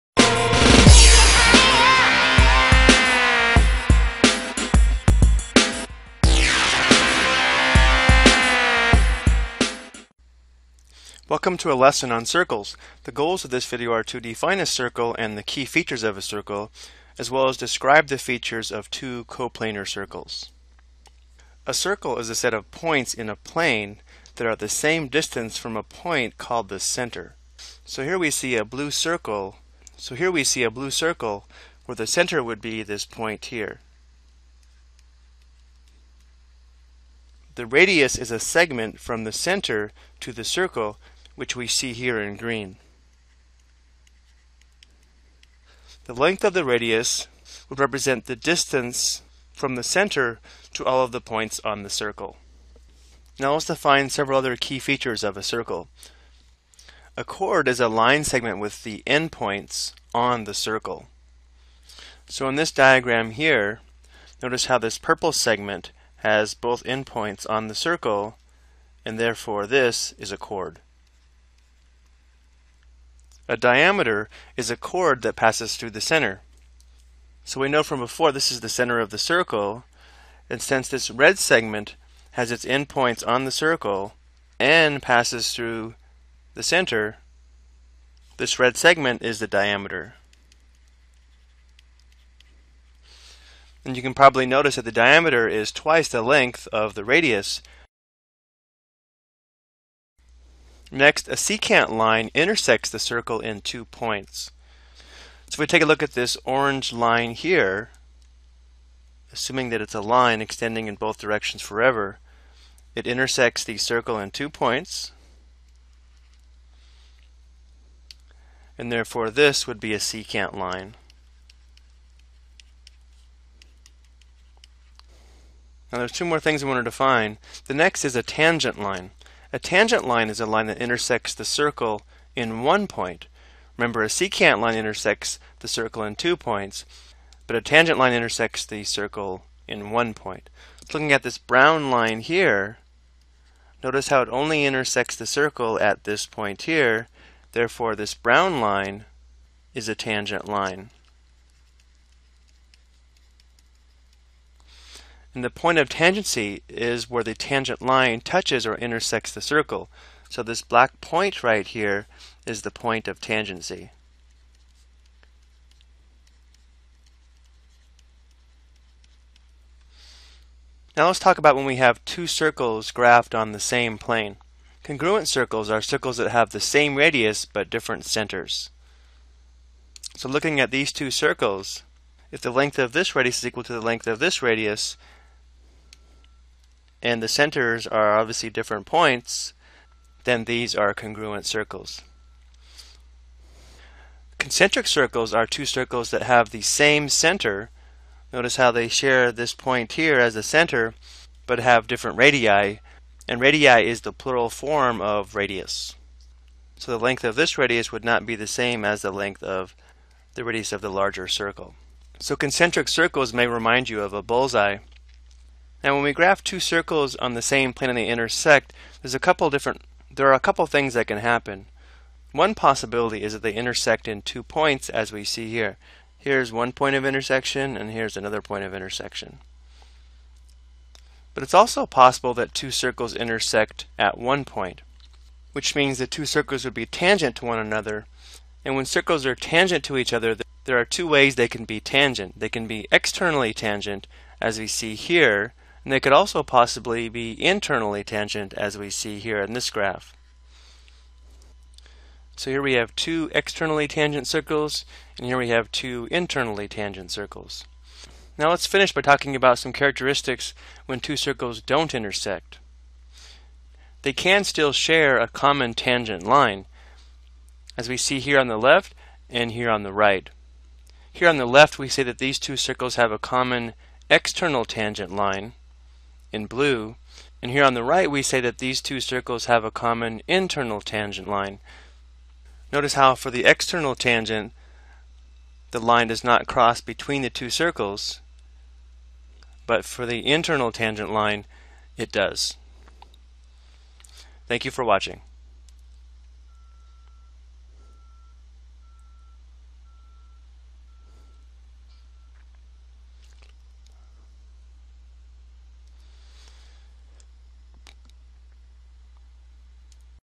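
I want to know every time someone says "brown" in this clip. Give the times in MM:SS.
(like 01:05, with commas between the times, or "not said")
02:21, 02:28.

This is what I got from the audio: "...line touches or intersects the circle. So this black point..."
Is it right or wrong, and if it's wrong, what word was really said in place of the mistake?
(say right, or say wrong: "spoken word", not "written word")
right.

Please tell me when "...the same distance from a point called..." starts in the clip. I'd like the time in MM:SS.
00:24.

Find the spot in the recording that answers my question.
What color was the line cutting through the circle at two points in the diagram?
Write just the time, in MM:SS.
01:46.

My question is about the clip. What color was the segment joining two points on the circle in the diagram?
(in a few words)
Purple.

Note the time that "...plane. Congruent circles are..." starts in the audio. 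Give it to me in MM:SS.
02:53.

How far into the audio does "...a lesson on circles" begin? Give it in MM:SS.
00:11.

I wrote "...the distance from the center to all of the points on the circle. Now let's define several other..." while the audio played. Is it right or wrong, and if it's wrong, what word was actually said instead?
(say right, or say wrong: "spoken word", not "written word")
right.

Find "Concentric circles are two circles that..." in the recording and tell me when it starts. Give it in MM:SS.
03:14.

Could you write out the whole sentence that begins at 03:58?
And when circles are tangent to each other, there are two ways they can be tangent.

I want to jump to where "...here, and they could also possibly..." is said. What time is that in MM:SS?
04:04.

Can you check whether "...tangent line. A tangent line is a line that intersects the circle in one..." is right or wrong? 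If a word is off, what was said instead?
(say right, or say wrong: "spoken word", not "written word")
right.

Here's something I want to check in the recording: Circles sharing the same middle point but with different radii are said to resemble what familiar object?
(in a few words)
A bullseye.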